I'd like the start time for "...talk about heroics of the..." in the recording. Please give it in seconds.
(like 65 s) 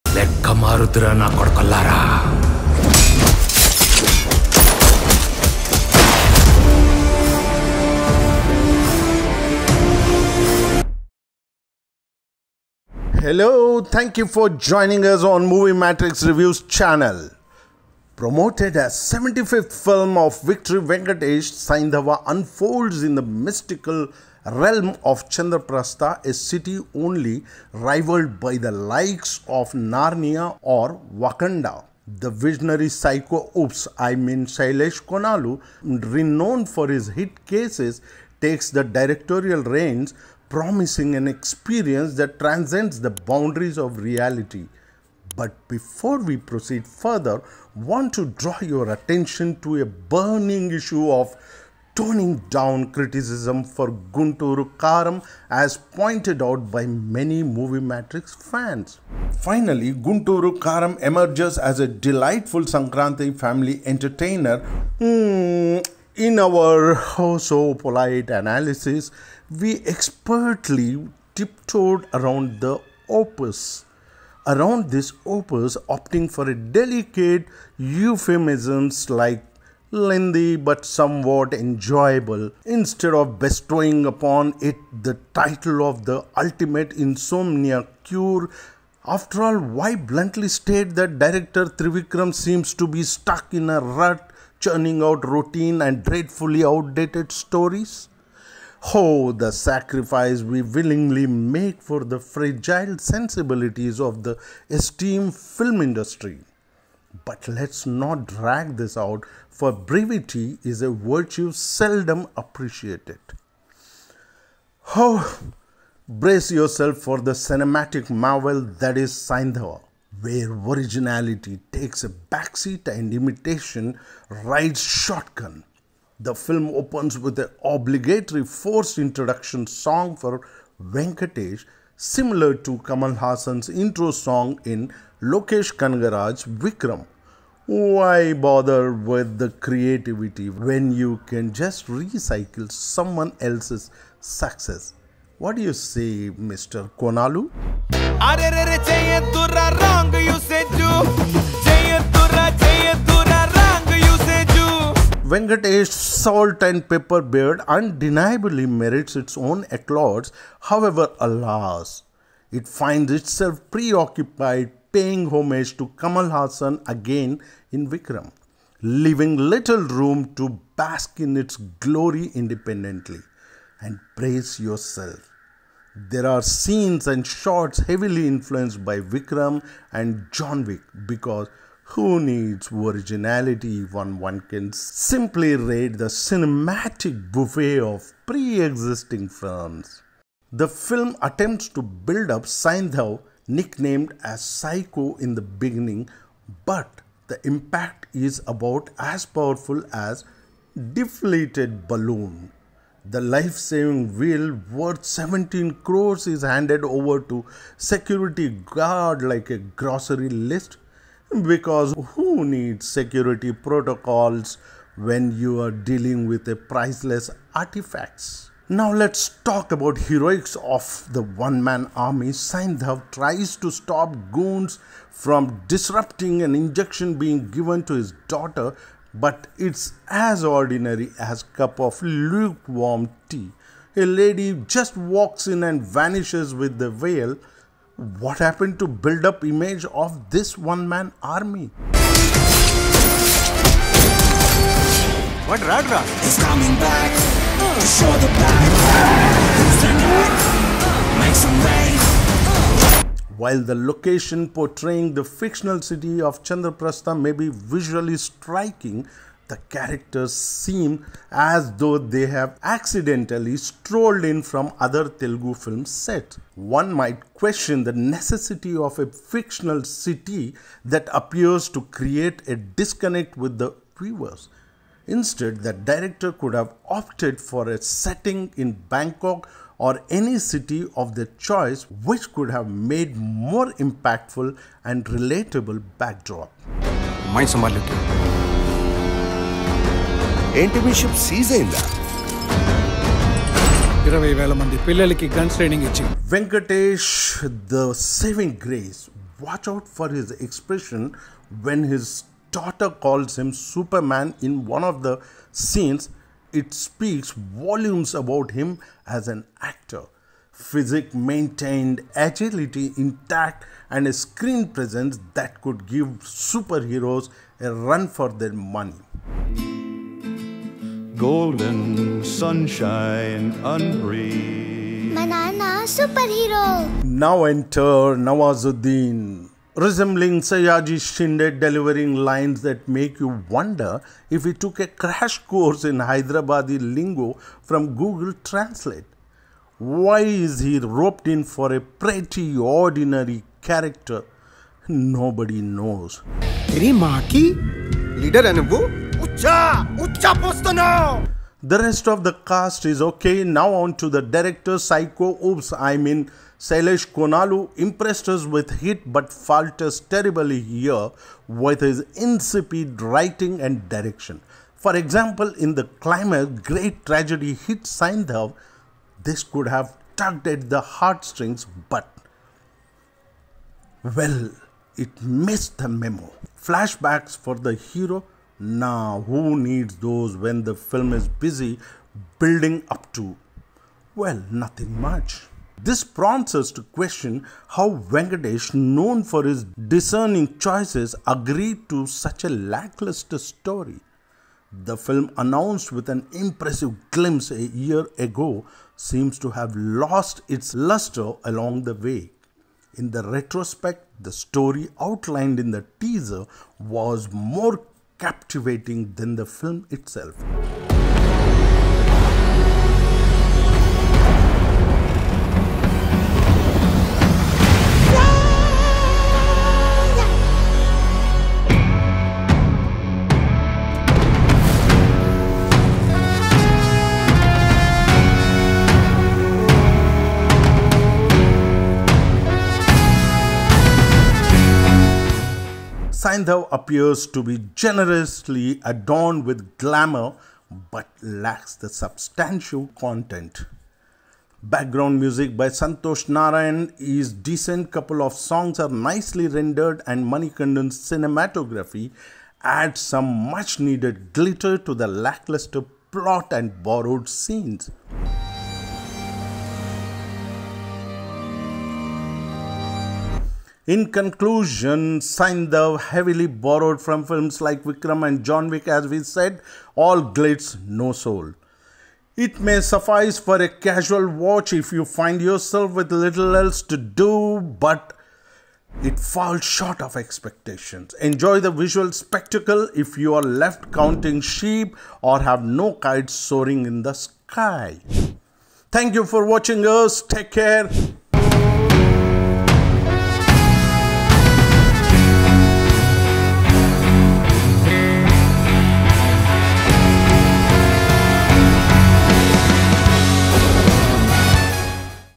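219 s.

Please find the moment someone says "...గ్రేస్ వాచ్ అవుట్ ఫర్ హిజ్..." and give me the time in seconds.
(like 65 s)
298 s.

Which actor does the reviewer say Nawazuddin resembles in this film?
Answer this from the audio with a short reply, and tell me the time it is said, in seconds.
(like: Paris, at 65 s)
Sayaji Shinde, at 330 s.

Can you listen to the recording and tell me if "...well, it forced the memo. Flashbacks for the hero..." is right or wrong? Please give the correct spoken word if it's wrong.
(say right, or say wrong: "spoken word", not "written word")
wrong: "missed", not "forced".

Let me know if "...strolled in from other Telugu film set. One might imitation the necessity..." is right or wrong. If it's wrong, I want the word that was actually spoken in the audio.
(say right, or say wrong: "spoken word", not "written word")
wrong: "question", not "imitation".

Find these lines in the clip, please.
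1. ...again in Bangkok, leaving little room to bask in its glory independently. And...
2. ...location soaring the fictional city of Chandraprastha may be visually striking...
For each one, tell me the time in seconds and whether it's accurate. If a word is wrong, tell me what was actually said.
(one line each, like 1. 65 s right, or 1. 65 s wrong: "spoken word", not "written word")
1. 166 s wrong: "Vikram", not "Bangkok"
2. 253 s wrong: "portraying", not "soaring".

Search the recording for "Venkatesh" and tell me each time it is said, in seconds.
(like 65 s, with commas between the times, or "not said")
20 s, 130 s, 155 s, 387 s.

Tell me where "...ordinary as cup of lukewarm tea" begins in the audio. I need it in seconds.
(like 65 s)
230 s.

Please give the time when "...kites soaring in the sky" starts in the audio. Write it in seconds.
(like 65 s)
485 s.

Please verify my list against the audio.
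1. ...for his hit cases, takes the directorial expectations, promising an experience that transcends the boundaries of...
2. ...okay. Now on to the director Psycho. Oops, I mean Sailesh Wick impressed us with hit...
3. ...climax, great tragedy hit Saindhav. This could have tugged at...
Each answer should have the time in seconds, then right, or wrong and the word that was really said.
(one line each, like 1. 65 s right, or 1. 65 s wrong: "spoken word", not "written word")
1. 36 s wrong: "reins", not "expectations"
2. 353 s wrong: "Konalu", not "Wick"
3. 365 s right.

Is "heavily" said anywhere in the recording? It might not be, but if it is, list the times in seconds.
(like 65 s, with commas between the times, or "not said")
177 s, 465 s.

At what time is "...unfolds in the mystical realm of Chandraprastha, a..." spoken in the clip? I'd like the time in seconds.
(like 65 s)
22 s.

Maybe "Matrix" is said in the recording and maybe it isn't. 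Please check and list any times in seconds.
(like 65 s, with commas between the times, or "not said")
15 s, 57 s.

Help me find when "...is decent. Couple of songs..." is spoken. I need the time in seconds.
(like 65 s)
446 s.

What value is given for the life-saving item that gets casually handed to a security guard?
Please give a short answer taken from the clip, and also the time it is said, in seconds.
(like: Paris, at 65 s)
17 crores, at 205 s.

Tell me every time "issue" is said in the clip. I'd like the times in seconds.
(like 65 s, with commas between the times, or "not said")
50 s.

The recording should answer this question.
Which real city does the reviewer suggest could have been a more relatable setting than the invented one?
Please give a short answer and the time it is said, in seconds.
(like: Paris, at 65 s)
Bangkok, at 278 s.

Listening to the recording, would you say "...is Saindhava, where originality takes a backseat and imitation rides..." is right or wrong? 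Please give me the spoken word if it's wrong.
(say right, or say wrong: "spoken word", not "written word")
right.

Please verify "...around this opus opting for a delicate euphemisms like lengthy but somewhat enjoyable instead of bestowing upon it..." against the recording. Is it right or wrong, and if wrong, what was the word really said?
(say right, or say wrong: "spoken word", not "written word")
right.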